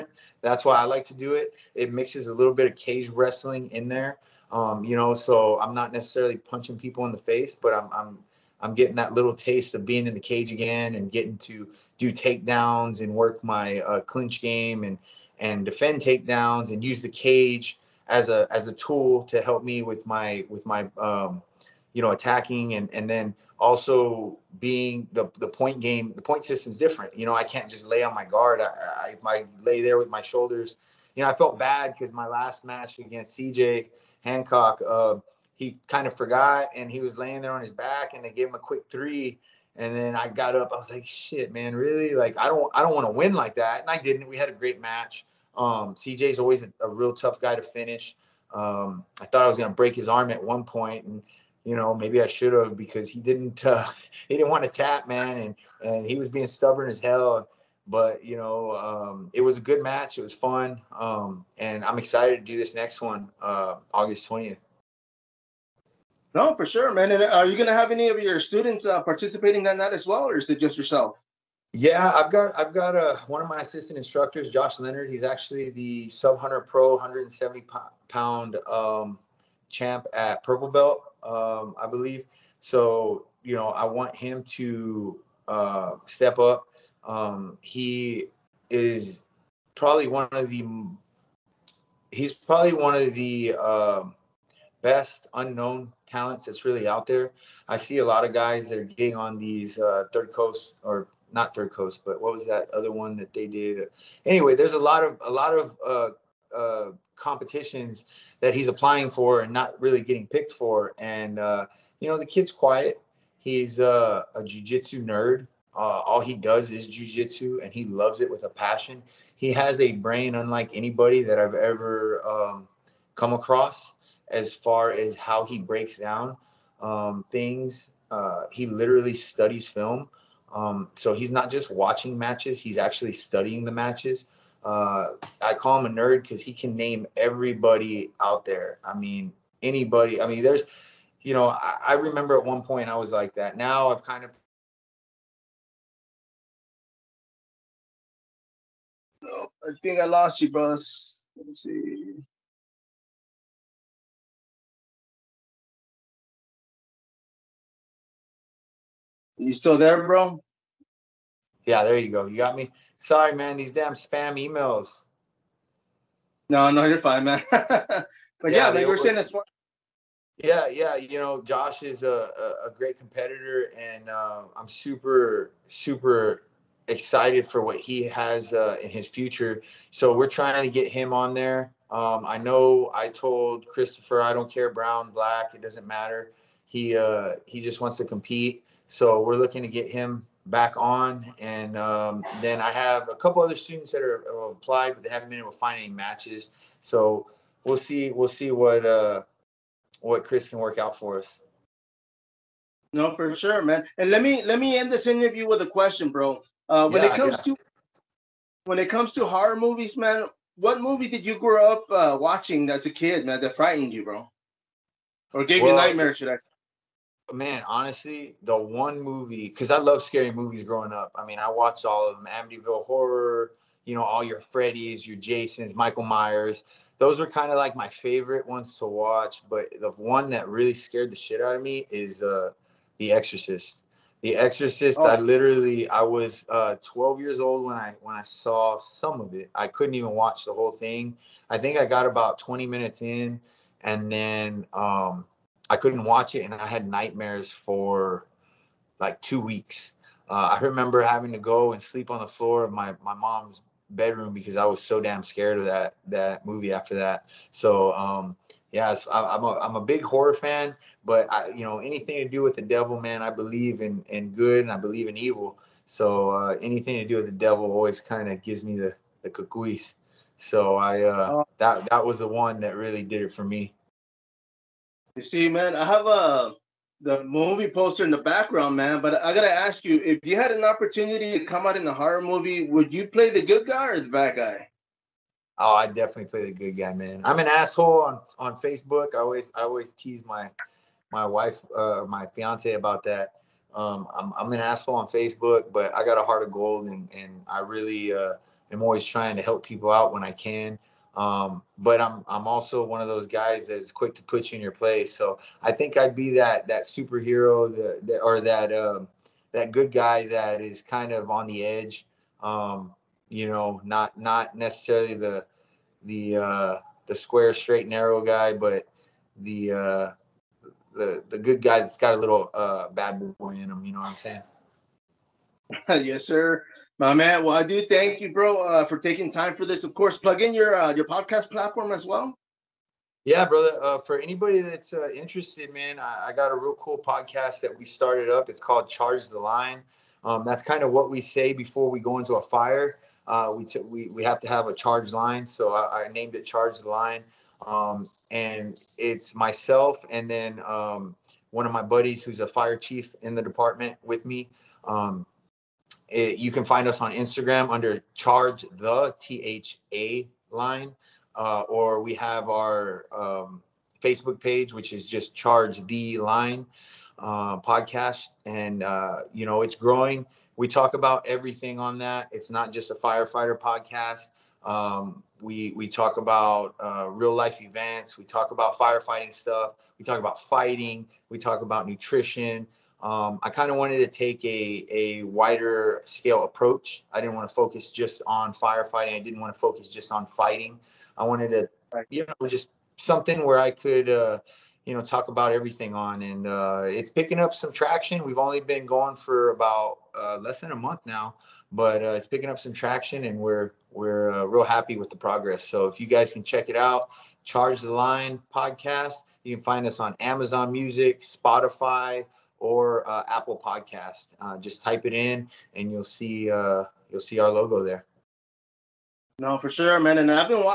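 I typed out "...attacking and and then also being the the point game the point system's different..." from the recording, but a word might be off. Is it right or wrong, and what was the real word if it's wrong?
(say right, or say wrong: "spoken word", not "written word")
right.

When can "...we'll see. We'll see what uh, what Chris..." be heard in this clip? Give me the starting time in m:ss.
3:17.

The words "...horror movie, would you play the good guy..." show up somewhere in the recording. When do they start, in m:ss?
4:41.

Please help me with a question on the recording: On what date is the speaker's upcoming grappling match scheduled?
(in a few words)
August 20th.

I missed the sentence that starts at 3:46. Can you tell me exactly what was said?
Those were kind of like my favorite ones to watch.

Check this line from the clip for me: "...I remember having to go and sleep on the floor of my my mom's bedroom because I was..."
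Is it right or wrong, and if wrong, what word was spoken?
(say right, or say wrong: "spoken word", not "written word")
right.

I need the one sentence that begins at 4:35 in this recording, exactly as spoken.
You see, man, I have a uh, the movie poster in the background, man.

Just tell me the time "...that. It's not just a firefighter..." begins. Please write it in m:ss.
6:11.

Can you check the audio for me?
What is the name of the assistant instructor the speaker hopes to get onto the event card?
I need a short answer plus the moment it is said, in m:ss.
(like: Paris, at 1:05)
Josh Leonard, at 1:14.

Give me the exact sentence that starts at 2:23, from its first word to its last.
Now I've kind of I think I lost you, bros.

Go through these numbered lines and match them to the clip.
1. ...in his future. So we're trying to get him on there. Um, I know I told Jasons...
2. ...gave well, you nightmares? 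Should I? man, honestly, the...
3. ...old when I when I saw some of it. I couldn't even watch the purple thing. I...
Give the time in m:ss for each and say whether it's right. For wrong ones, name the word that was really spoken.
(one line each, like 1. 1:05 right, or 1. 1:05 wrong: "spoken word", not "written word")
1. 2:58 wrong: "Christopher", not "Jasons"
2. 3:35 right
3. 3:57 wrong: "whole", not "purple".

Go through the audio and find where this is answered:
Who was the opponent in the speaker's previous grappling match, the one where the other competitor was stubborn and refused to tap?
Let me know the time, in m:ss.
0:33.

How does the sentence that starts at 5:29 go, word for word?
Of course, plug in your uh, your podcast platform as well.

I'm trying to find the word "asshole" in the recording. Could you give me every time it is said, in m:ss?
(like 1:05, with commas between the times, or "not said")
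4:47, 4:54.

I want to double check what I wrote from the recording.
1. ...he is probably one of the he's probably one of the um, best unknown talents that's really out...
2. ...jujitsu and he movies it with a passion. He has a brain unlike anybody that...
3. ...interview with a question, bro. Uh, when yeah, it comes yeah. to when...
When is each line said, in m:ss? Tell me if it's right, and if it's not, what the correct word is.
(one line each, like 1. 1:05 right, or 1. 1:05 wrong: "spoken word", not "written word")
1. 1:27 right
2. 1:56 wrong: "loves", not "movies"
3. 3:25 right.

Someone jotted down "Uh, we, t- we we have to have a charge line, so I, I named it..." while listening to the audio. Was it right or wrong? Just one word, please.
right.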